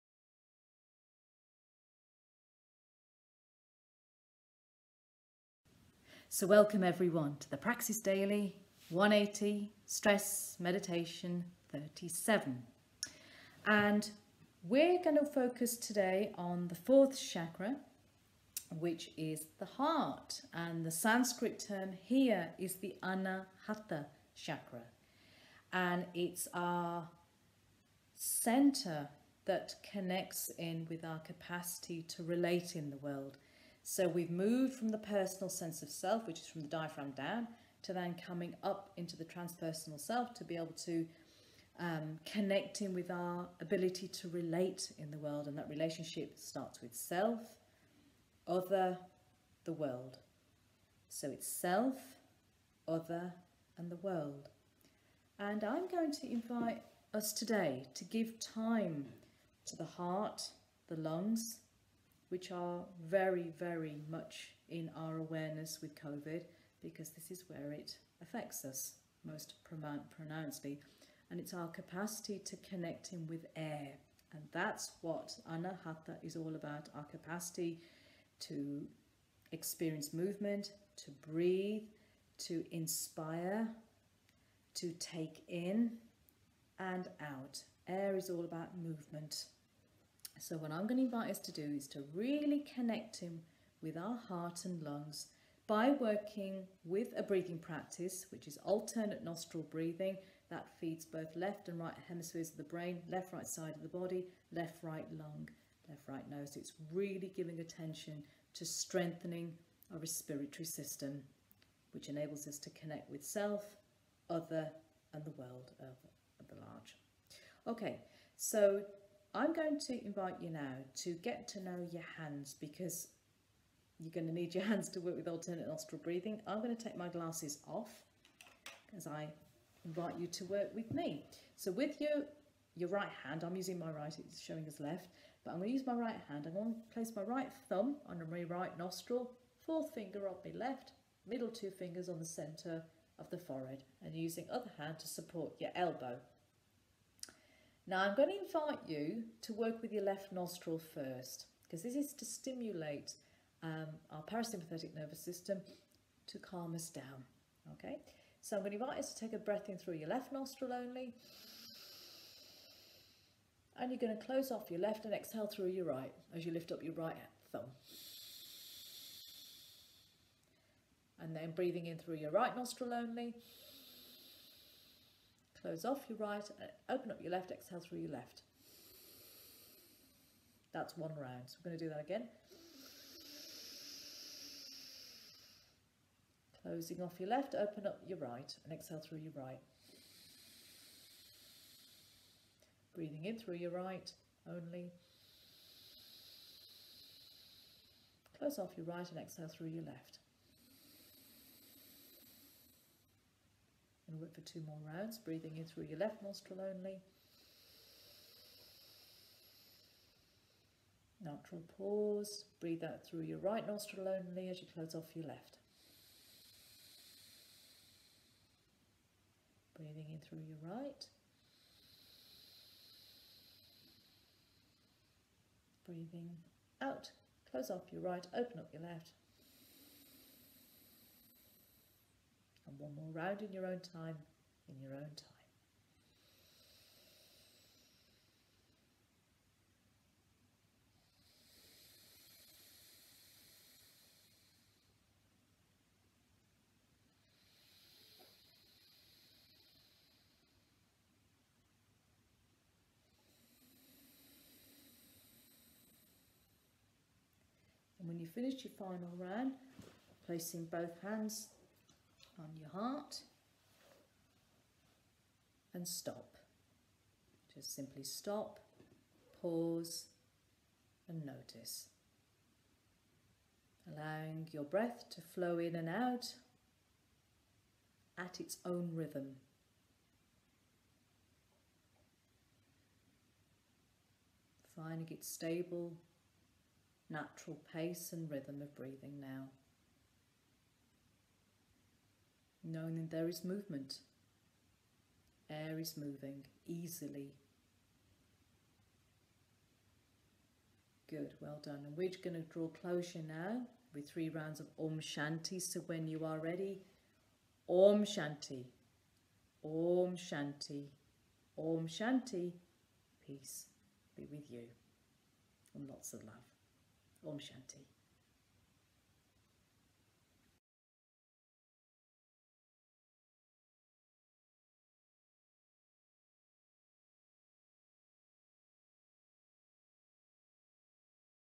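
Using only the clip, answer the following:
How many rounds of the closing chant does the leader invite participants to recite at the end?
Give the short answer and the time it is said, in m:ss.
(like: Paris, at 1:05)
3, at 5:04.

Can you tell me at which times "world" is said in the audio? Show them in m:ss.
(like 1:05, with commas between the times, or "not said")
0:32, 0:45, 0:49, 0:53, 1:55.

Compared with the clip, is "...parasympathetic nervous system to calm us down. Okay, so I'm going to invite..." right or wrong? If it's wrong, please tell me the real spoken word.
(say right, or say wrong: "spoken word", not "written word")
right.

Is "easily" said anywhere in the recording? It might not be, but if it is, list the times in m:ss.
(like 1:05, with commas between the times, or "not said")
4:56.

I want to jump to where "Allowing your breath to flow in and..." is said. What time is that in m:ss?
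4:33.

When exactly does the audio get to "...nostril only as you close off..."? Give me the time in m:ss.
3:33.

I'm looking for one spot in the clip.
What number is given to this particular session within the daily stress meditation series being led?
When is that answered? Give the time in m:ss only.
0:11.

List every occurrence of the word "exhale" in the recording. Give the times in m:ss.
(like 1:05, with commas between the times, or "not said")
2:45, 2:57, 3:08, 3:19.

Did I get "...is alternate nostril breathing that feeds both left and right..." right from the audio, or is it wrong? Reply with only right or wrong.
right.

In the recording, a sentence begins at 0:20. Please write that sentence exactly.
And the Sanskrit term here is the Anahata chakra.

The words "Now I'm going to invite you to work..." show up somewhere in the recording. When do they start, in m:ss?
2:27.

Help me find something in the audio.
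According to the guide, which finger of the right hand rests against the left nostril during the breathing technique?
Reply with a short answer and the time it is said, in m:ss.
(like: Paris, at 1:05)
fourth finger, at 2:19.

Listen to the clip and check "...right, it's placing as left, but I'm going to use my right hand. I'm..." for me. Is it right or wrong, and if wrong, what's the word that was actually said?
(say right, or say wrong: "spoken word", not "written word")
wrong: "showing", not "placing".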